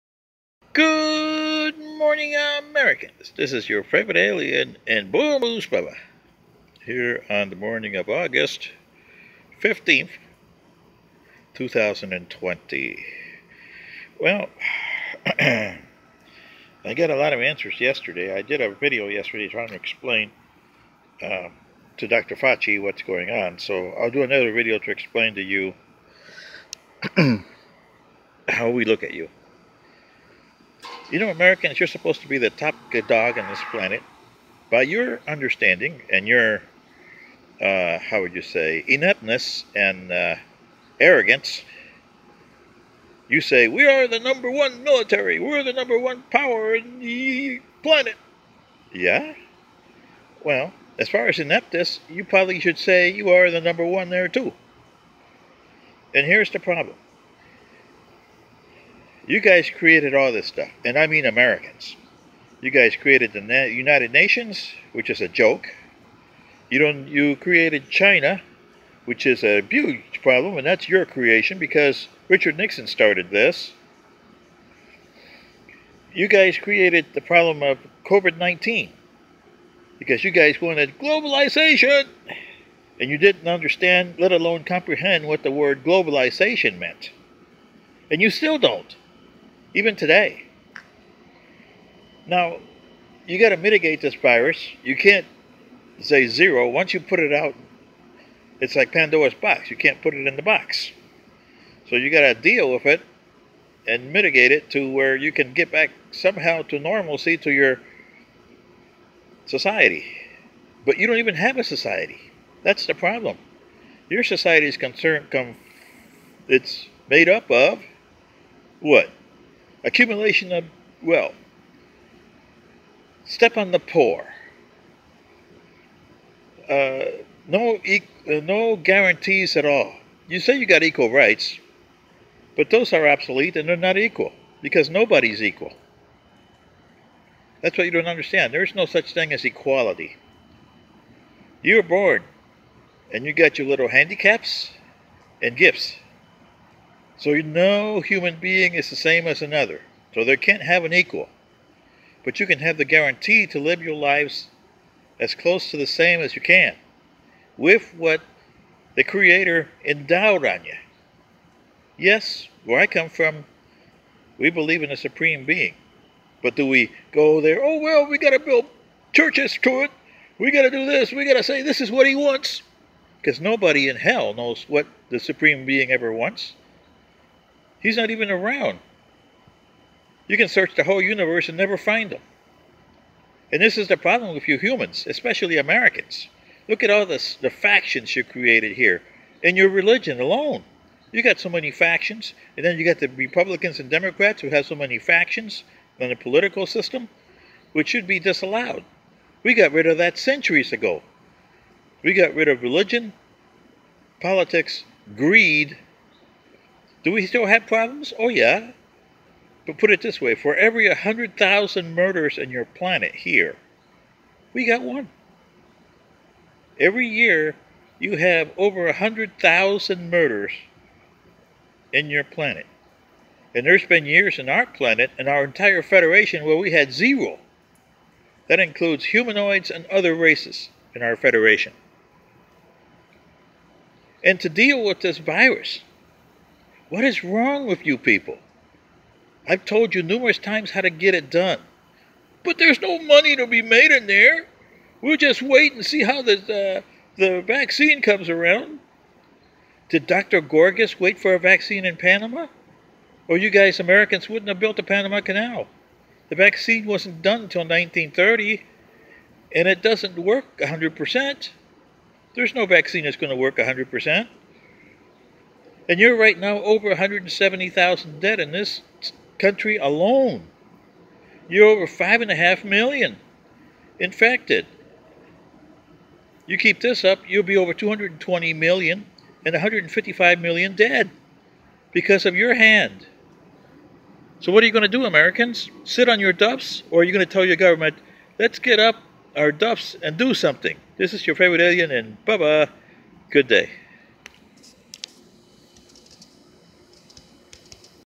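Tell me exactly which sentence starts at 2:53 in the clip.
Because nobody in hell knows what the supreme being ever wants.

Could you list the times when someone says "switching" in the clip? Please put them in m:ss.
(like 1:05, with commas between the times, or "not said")
not said.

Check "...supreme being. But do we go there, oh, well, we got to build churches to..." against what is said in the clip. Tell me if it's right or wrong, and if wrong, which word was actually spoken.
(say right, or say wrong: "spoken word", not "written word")
right.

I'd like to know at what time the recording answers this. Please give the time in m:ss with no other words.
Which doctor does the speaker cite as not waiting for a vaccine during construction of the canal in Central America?
4:10.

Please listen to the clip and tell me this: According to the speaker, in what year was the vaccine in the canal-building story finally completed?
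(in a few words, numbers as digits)
1930.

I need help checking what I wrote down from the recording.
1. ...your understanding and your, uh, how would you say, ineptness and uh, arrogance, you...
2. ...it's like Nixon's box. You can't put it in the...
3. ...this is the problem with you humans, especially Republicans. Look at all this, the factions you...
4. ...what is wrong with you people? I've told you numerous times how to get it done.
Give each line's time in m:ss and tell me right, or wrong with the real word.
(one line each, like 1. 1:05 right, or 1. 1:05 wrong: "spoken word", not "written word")
1. 0:34 right
2. 1:38 wrong: "Pandora", not "Nixon"
3. 3:03 wrong: "Americans", not "Republicans"
4. 3:56 right.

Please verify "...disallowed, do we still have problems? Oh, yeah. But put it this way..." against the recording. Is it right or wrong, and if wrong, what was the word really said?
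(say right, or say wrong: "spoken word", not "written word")
wrong: "greed", not "disallowed".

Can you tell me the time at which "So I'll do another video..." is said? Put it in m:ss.
0:23.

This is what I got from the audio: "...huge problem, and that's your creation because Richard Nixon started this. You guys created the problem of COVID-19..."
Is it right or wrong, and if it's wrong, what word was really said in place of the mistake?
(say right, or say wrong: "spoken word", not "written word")
right.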